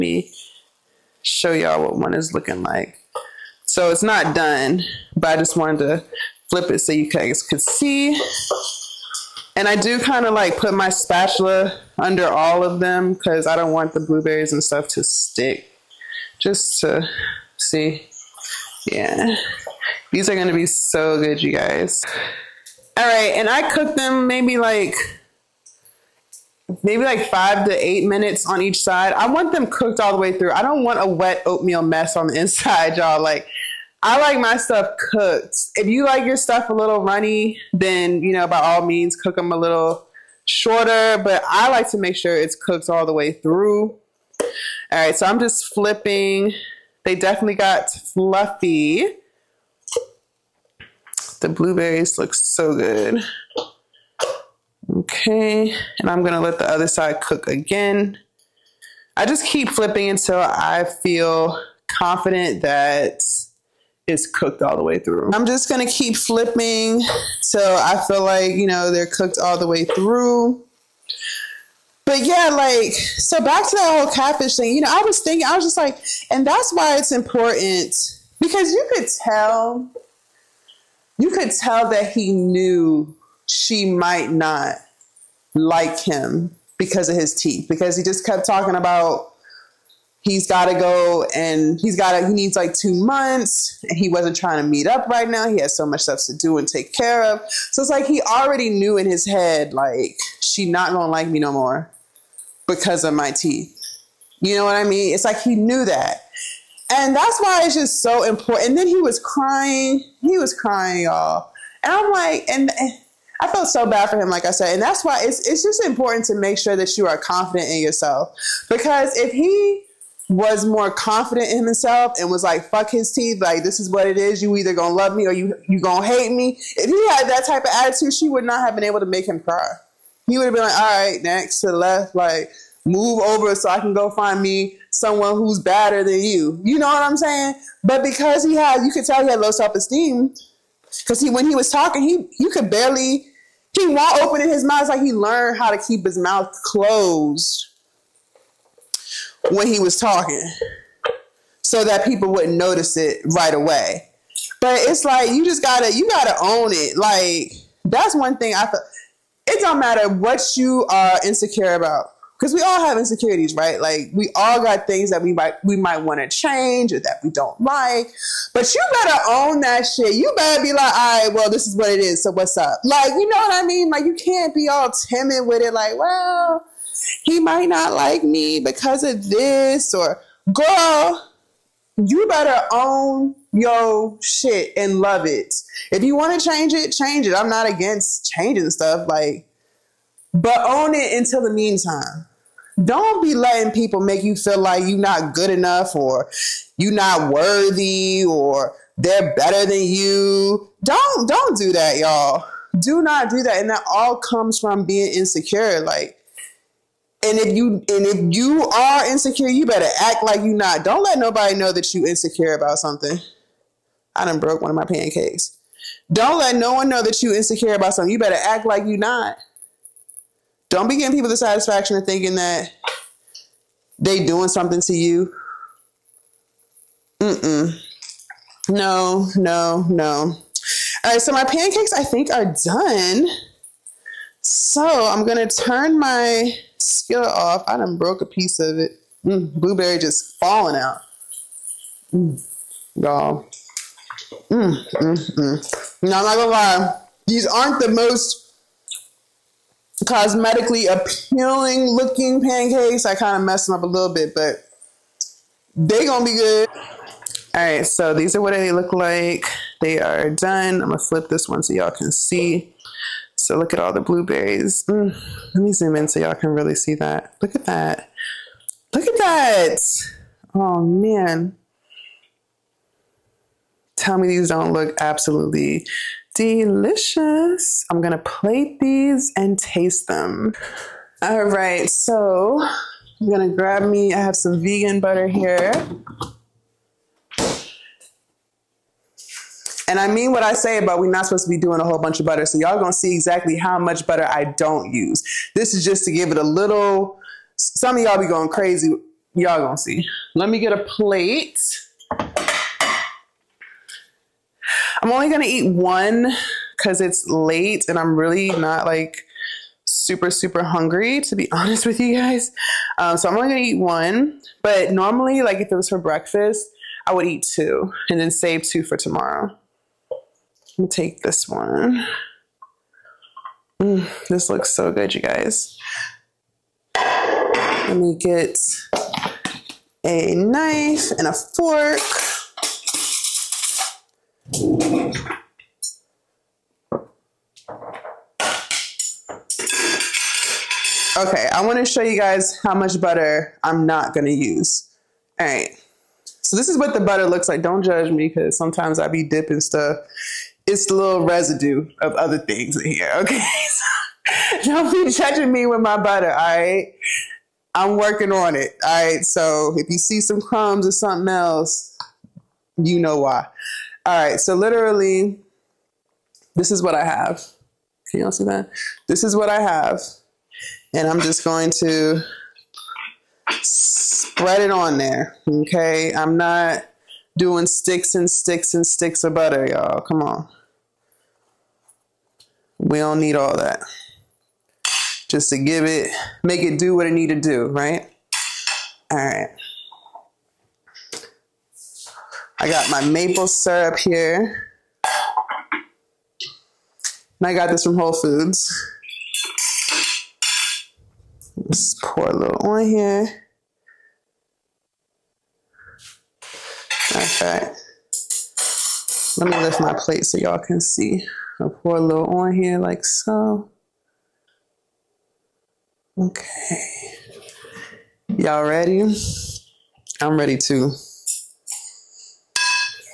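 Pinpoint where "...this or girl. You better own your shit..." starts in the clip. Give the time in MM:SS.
02:59.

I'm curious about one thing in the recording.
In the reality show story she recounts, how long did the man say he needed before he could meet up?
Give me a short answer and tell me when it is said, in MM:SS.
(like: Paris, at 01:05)
2 months, at 01:32.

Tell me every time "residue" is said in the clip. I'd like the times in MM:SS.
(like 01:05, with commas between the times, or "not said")
05:51.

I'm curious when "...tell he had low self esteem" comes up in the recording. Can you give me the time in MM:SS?
02:19.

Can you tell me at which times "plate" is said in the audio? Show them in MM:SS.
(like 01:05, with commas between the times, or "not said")
04:38, 05:00, 06:49.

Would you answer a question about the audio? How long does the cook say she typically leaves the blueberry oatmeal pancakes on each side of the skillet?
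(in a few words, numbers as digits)
5 to 8 minutes.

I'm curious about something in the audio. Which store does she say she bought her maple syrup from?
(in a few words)
Whole Foods.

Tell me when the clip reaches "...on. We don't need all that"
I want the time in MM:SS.
06:20.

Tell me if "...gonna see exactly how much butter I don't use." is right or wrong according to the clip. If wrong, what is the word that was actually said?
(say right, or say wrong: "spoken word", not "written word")
right.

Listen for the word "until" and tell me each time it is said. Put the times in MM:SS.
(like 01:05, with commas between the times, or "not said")
01:00, 03:11.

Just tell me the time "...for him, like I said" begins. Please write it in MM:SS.
01:54.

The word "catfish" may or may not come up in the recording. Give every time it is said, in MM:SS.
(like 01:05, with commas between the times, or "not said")
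01:14.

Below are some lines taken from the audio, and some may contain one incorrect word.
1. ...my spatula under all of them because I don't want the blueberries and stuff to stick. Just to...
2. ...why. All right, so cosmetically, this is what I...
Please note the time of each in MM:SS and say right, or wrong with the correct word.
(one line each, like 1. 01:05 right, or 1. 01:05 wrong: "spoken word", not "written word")
1. 00:10 right
2. 06:03 wrong: "literally", not "cosmetically".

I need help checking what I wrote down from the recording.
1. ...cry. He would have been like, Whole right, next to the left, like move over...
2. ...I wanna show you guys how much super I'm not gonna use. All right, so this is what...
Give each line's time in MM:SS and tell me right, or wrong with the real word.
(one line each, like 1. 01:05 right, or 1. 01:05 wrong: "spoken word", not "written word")
1. 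02:09 wrong: "All", not "Whole"
2. 05:41 wrong: "butter", not "super".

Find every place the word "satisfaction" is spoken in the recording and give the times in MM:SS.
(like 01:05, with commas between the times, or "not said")
03:41.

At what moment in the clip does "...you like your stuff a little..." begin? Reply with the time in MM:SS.
00:35.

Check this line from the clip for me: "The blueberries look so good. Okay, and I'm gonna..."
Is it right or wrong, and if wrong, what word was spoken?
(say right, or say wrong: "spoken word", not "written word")
right.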